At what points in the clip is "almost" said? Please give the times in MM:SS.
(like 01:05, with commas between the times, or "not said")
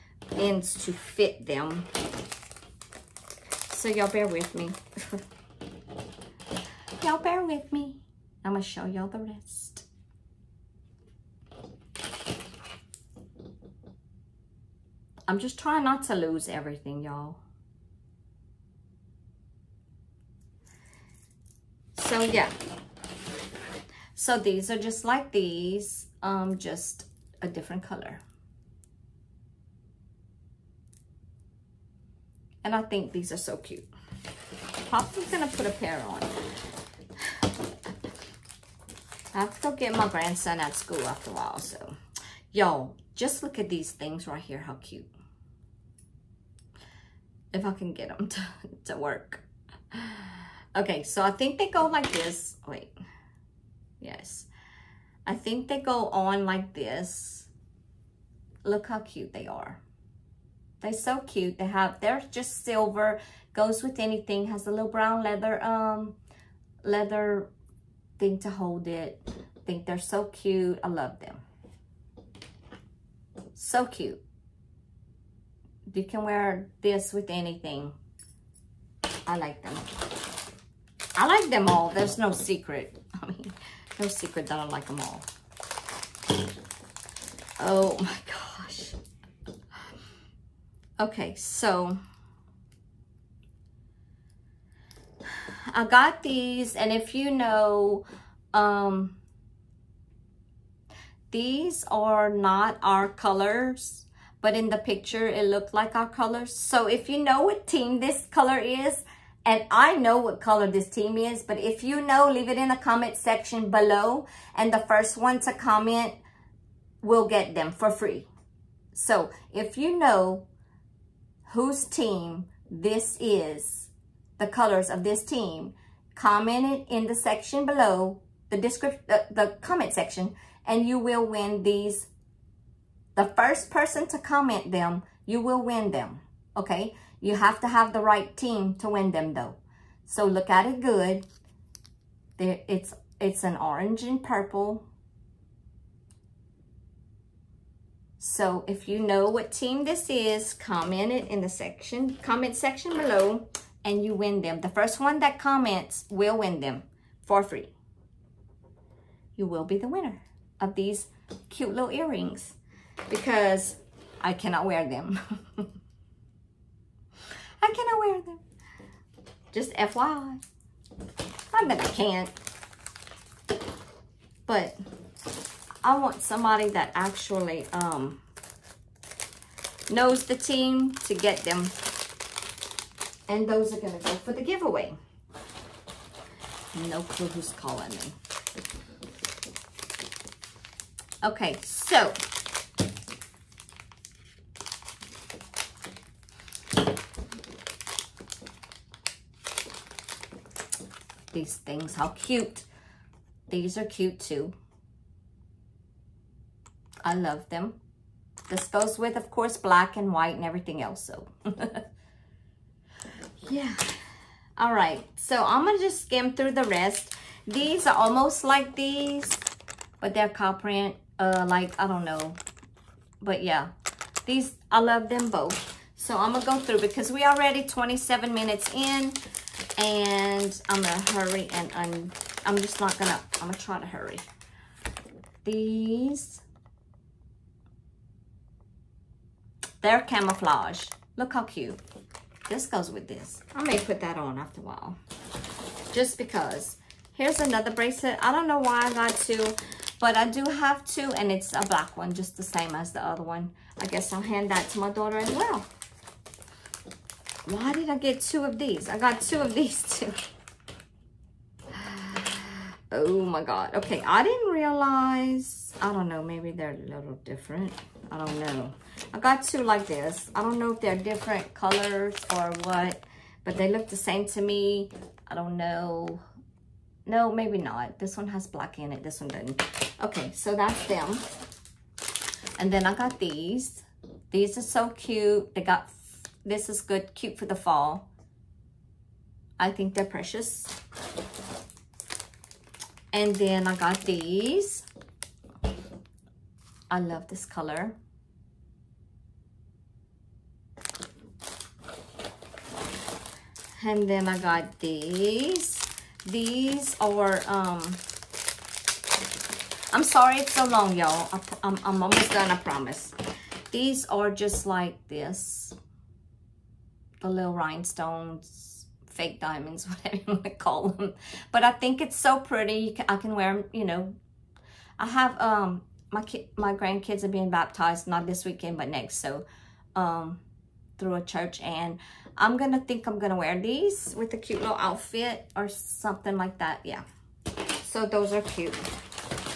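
03:37, 05:12.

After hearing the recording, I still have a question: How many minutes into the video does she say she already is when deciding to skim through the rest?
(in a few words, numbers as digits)
27.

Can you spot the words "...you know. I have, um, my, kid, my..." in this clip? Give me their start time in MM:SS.
05:23.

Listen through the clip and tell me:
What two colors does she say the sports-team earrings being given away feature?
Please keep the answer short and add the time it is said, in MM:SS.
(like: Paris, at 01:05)
orange and purple, at 02:23.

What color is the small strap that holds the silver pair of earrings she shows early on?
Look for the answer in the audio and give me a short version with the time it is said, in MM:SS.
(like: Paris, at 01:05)
brown, at 01:04.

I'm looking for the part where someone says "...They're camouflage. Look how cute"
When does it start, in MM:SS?
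03:59.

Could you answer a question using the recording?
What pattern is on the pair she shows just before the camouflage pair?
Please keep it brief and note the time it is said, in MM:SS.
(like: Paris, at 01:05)
cow print, at 03:40.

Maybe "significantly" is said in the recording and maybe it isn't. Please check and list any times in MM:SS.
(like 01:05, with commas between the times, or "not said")
not said.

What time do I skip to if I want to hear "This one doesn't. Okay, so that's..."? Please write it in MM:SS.
04:39.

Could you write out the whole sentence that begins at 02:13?
The first person to comment them, you will win them, okay?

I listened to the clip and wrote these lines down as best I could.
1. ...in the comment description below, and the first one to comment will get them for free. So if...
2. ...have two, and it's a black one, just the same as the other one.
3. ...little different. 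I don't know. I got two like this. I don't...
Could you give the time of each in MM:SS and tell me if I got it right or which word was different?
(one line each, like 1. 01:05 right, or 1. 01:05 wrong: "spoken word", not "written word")
1. 01:52 wrong: "section", not "description"
2. 04:10 right
3. 04:26 right.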